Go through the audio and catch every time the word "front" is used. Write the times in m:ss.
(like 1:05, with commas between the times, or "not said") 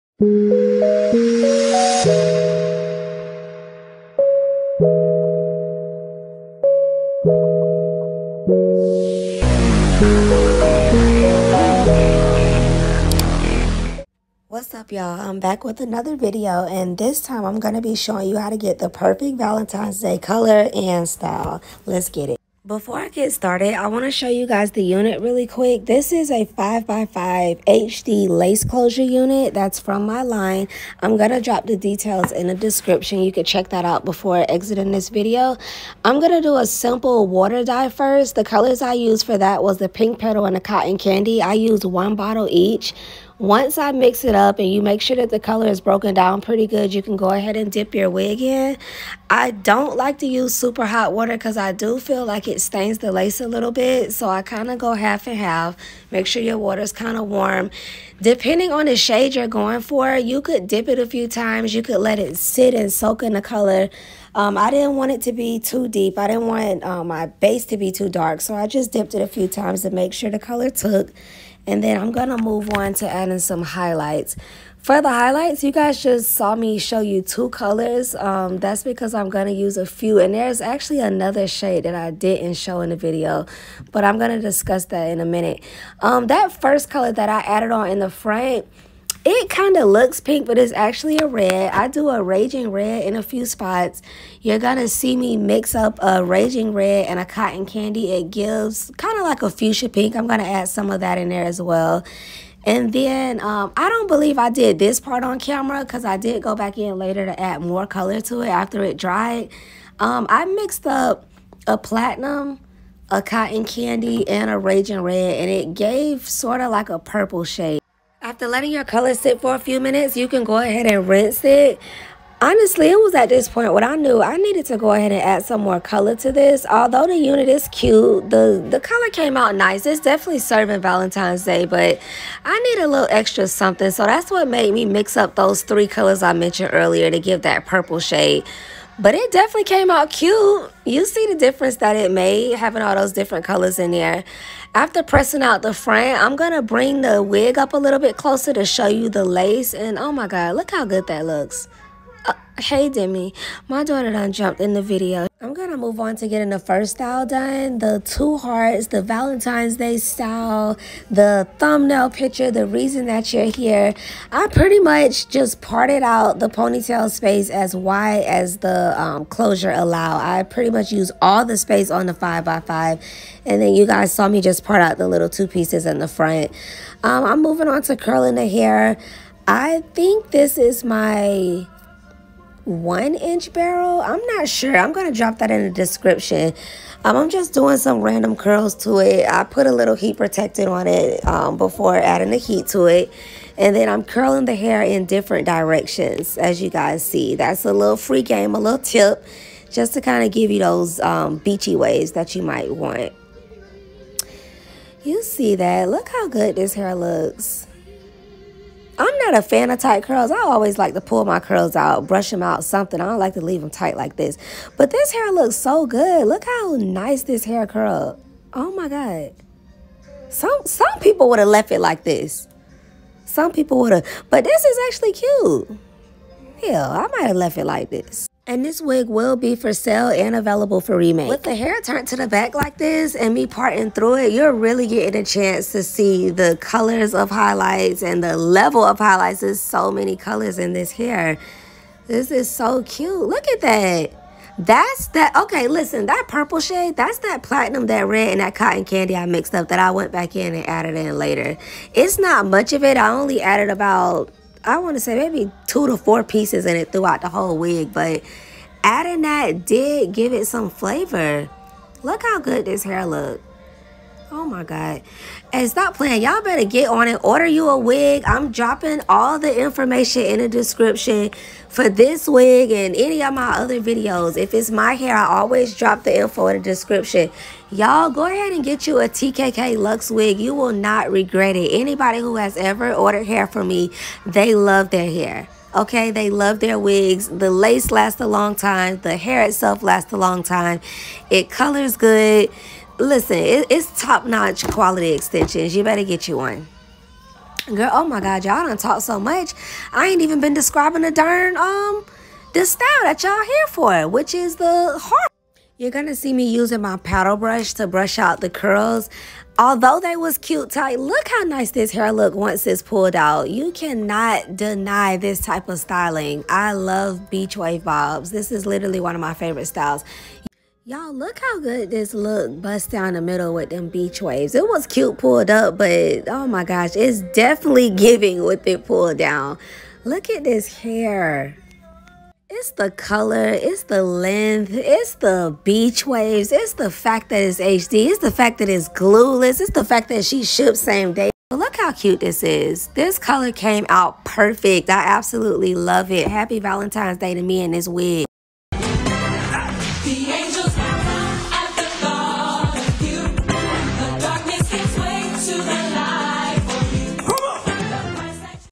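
2:25, 2:56.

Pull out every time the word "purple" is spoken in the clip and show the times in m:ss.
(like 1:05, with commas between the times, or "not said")
1:56, 2:17, 4:06.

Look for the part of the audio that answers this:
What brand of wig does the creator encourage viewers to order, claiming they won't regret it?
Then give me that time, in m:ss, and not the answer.
4:39.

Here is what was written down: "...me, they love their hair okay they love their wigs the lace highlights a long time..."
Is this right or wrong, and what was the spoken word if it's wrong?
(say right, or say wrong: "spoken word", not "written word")
wrong: "lasts", not "highlights".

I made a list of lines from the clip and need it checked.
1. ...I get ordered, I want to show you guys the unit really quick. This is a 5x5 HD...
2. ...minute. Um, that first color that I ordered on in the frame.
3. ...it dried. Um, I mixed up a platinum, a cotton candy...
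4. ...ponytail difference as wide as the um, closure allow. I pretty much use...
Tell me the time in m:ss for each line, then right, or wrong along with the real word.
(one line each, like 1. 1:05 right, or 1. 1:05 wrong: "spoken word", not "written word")
1. 0:22 wrong: "started", not "ordered"
2. 1:25 wrong: "added", not "ordered"
3. 1:48 right
4. 2:46 wrong: "space", not "difference".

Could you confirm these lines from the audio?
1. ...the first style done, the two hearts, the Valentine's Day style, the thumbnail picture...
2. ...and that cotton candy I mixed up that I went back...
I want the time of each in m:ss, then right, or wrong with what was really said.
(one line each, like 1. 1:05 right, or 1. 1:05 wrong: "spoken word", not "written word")
1. 2:36 right
2. 4:08 right.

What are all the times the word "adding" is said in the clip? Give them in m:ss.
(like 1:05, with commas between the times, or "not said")
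1:13, 3:11, 4:18.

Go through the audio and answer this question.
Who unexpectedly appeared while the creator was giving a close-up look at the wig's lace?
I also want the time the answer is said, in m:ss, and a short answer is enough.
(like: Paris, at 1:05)
Demi, at 2:32.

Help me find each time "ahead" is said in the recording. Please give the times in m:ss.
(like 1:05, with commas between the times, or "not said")
0:47, 2:00, 2:04, 4:38.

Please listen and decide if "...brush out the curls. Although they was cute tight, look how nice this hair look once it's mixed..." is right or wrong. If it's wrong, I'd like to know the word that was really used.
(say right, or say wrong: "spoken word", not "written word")
wrong: "pulled", not "mixed".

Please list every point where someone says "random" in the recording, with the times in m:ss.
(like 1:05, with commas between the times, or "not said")
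3:08.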